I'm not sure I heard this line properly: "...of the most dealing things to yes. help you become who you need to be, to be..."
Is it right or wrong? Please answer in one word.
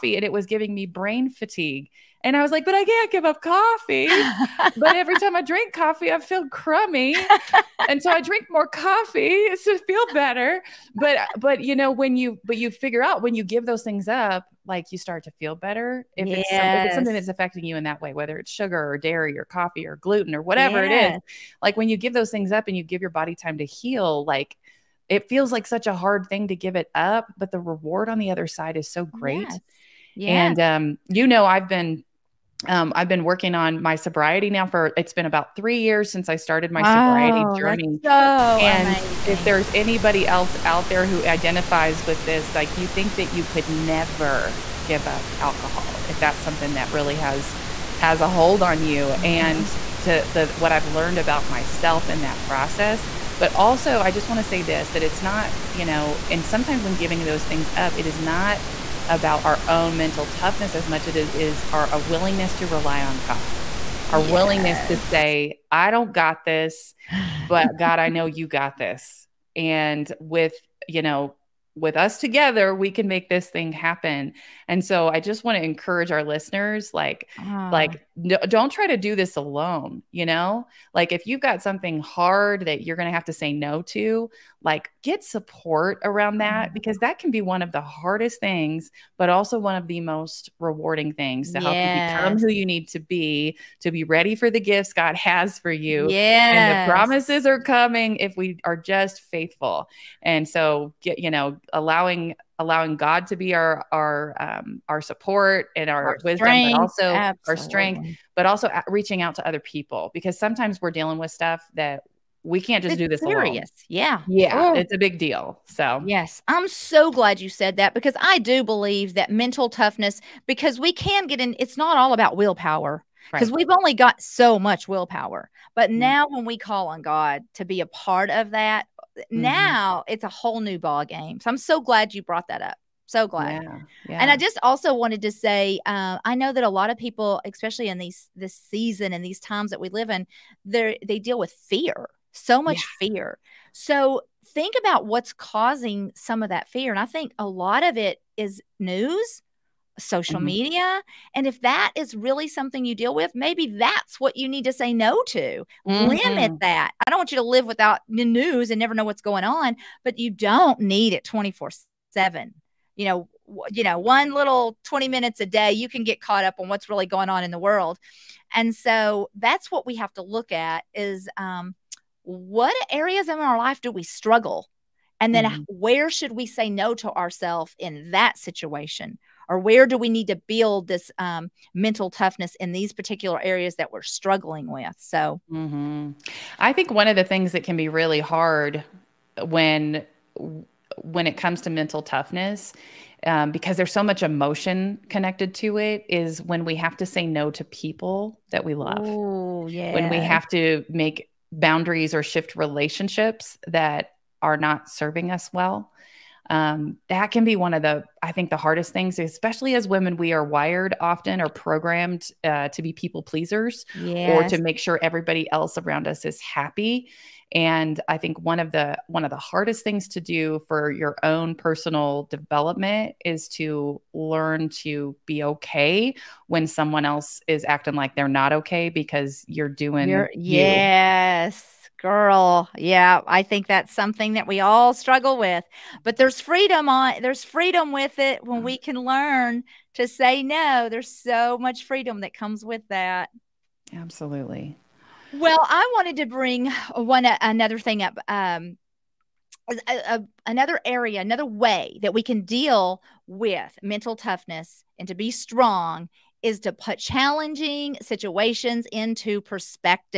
wrong.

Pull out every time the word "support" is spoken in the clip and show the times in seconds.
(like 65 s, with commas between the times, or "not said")
85 s, 105 s.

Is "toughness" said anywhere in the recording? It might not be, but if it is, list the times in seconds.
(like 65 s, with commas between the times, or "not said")
60 s, 119 s, 182 s, 192 s, 254 s.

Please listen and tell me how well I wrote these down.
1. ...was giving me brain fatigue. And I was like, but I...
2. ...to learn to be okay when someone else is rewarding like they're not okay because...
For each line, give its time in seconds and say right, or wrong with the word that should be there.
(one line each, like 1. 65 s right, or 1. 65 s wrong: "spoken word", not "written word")
1. 0 s right
2. 223 s wrong: "acting", not "rewarding".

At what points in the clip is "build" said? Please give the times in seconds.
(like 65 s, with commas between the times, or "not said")
180 s.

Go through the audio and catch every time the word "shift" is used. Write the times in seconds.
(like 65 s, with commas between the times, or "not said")
202 s.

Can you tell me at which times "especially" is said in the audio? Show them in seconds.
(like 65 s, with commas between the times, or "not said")
137 s, 209 s.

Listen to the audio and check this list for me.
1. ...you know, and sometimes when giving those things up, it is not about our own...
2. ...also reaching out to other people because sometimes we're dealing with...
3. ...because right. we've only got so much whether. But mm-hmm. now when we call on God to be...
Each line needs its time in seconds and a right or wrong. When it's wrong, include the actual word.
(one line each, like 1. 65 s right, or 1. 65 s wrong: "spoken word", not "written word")
1. 55 s right
2. 108 s right
3. 123 s wrong: "willpower", not "whether".